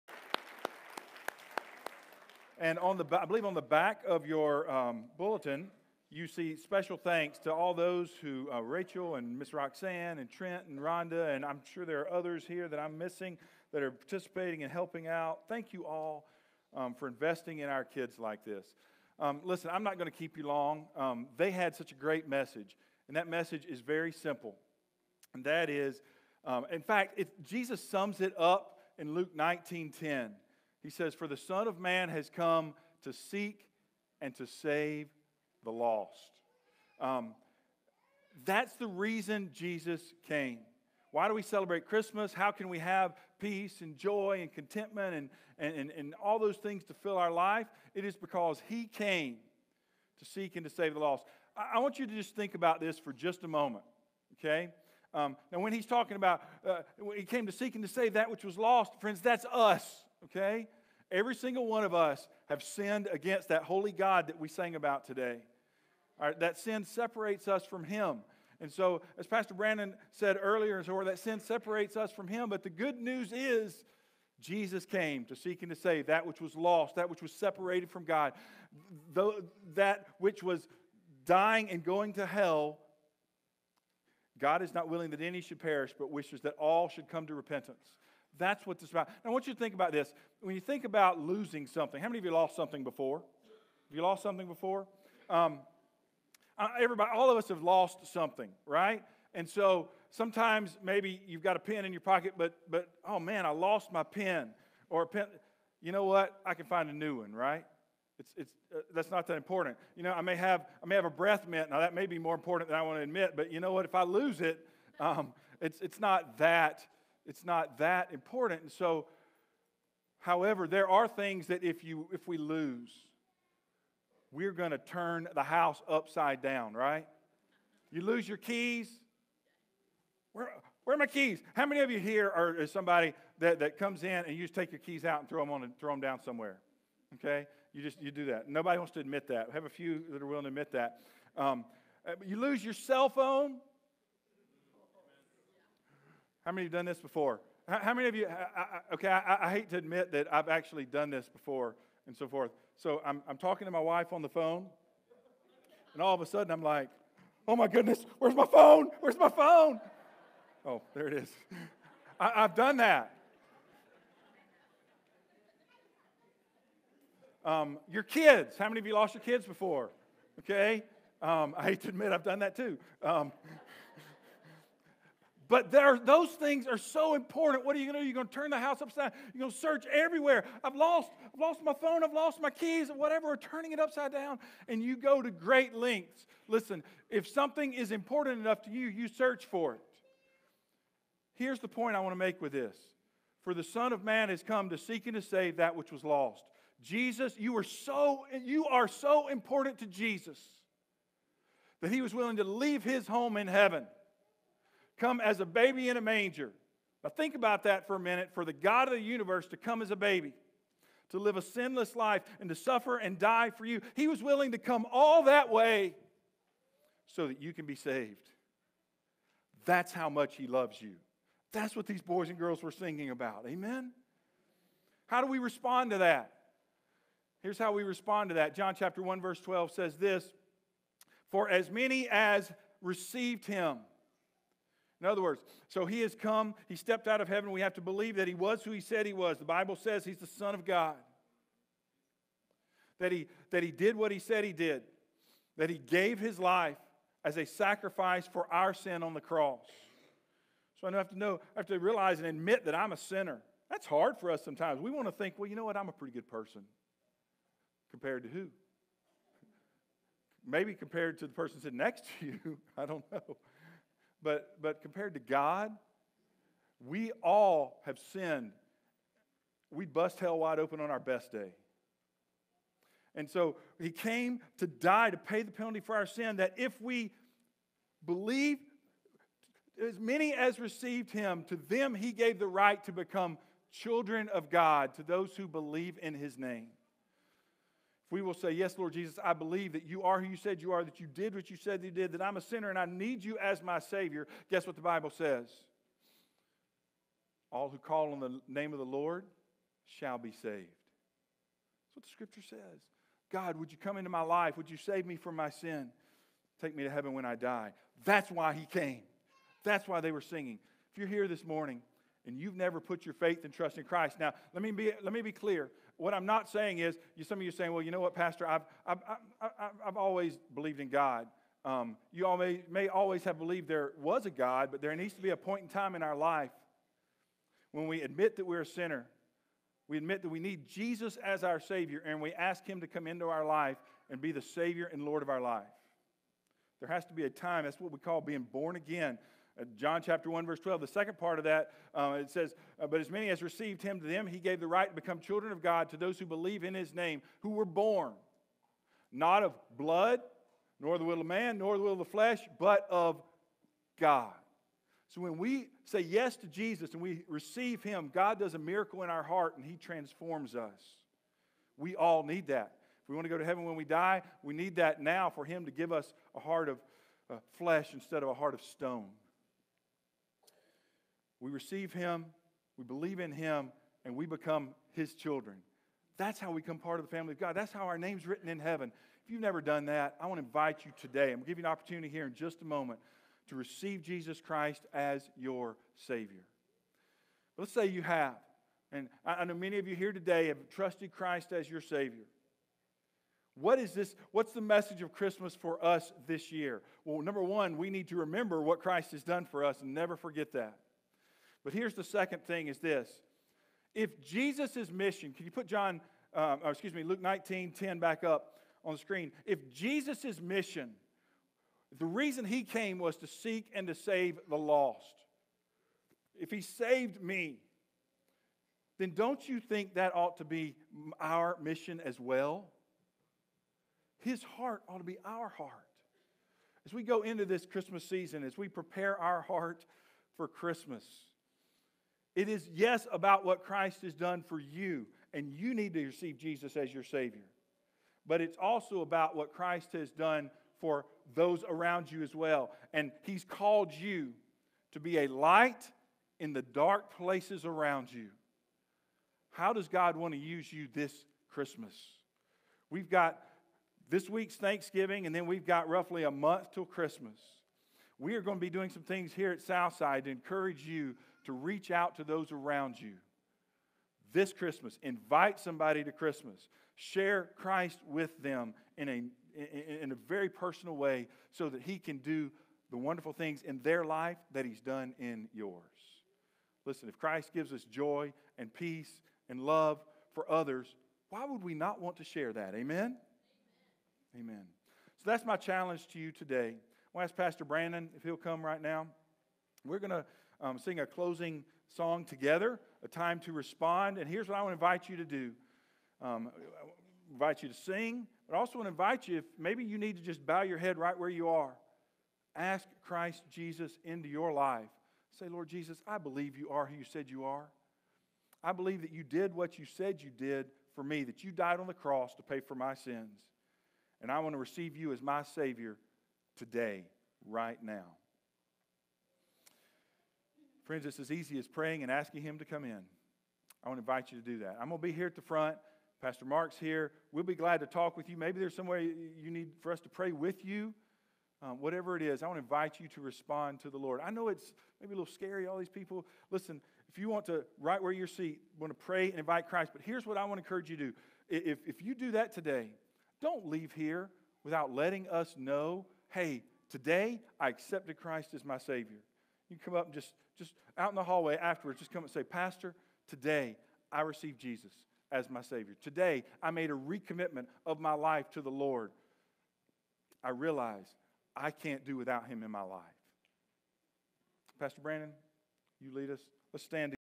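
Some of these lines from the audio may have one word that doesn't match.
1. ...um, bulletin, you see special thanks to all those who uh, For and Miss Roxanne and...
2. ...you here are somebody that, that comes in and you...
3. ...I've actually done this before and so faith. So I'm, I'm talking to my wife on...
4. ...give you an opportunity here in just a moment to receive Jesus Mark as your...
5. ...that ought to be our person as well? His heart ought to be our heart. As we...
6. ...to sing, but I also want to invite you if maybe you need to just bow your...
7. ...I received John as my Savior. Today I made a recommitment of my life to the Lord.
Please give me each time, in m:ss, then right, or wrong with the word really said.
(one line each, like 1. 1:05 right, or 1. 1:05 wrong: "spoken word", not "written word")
1. 0:04 wrong: "Rachel", not "For"
2. 2:11 right
3. 2:30 wrong: "forth", not "faith"
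4. 6:21 wrong: "Christ", not "Mark"
5. 6:59 wrong: "mission", not "person"
6. 8:17 right
7. 9:14 wrong: "Jesus", not "John".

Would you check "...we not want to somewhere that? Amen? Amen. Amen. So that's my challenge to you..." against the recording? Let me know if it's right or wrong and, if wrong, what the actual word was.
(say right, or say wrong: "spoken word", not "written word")
wrong: "share", not "somewhere".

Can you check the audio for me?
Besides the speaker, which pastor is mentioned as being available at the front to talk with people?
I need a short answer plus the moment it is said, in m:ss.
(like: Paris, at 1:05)
Pastor Mark, at 8:46.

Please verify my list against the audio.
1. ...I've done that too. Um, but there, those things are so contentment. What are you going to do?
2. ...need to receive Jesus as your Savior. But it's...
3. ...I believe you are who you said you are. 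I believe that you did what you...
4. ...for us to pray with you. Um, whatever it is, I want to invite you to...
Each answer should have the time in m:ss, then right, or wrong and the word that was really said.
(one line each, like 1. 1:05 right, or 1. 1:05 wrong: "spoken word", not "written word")
1. 2:52 wrong: "important", not "contentment"
2. 7:15 right
3. 8:26 right
4. 8:49 right.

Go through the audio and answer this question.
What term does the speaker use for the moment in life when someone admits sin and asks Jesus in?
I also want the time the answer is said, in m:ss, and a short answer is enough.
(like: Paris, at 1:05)
Being born again, at 5:38.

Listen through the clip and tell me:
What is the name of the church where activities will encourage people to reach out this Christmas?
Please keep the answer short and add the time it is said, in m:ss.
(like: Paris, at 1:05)
Southside, at 7:39.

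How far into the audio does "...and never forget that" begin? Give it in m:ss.
6:39.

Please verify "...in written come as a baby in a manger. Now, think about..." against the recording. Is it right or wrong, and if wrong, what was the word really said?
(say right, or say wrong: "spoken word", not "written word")
wrong: "heaven", not "written".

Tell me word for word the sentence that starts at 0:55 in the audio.
Um, now, when He's talking about uh, He came to seek and to save that which was lost, friends, that's us, okay?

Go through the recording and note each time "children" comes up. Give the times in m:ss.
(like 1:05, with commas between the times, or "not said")
4:43, 5:45, 6:15.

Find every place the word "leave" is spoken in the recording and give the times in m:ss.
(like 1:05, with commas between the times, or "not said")
3:22, 9:03.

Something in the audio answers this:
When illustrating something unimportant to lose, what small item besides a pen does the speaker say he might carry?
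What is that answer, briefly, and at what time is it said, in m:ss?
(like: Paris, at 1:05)
A breath mint, at 1:51.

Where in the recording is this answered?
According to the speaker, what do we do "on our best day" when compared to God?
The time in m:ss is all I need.
4:29.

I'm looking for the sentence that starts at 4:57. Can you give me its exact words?
All who call on the name of the Lord shall be saved.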